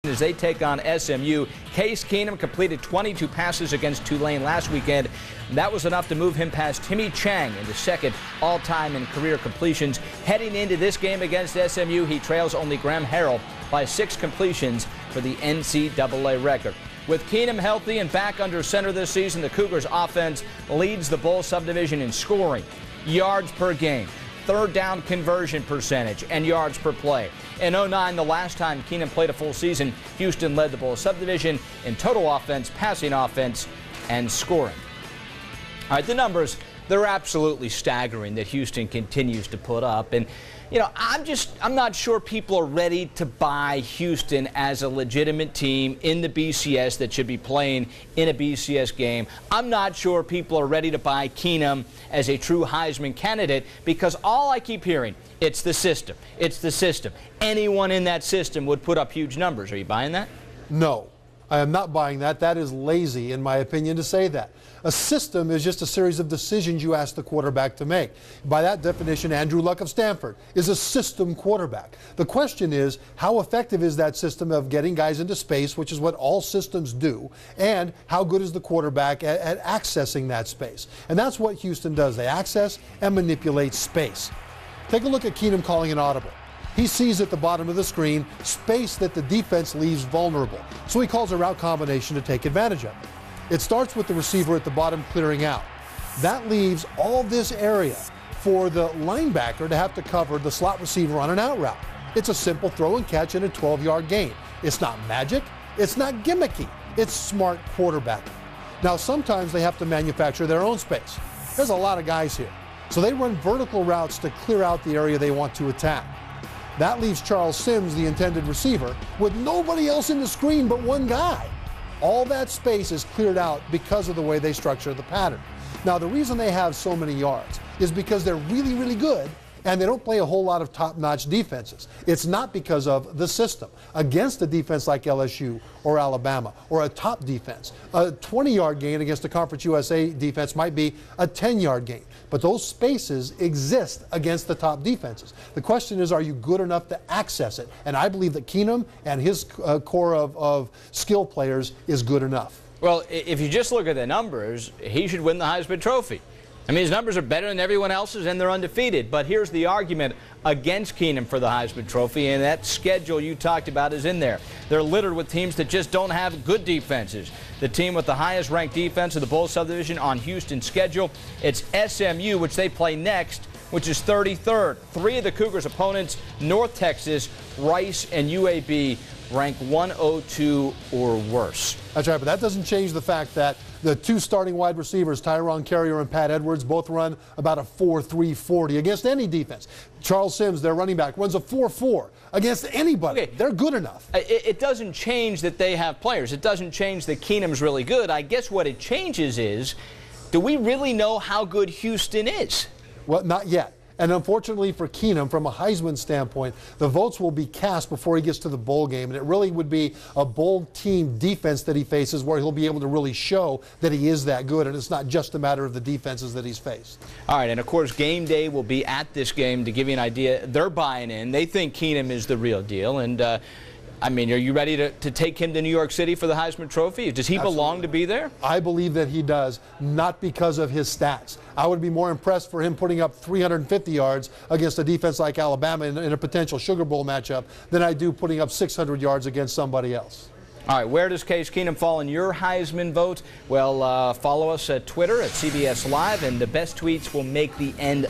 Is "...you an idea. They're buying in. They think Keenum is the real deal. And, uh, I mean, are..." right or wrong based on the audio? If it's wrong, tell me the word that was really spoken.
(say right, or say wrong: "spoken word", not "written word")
right.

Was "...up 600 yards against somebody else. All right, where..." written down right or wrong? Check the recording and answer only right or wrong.
right.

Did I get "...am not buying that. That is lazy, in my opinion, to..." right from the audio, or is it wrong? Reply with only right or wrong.
right.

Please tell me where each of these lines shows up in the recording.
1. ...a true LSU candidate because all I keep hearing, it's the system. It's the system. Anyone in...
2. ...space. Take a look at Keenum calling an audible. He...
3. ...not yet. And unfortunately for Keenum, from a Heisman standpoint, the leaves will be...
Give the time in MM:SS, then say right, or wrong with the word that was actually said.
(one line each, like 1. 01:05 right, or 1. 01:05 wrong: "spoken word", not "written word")
1. 00:52 wrong: "Heisman", not "LSU"
2. 01:23 right
3. 03:23 wrong: "votes", not "leaves".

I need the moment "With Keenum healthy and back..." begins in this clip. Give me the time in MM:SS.
00:17.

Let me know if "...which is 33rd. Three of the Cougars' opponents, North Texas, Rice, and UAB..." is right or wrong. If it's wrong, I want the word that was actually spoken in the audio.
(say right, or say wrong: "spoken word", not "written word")
right.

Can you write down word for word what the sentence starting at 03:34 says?
And it's not just a matter of the defenses that he's faced.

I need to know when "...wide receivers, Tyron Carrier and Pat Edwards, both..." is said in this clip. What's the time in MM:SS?
03:04.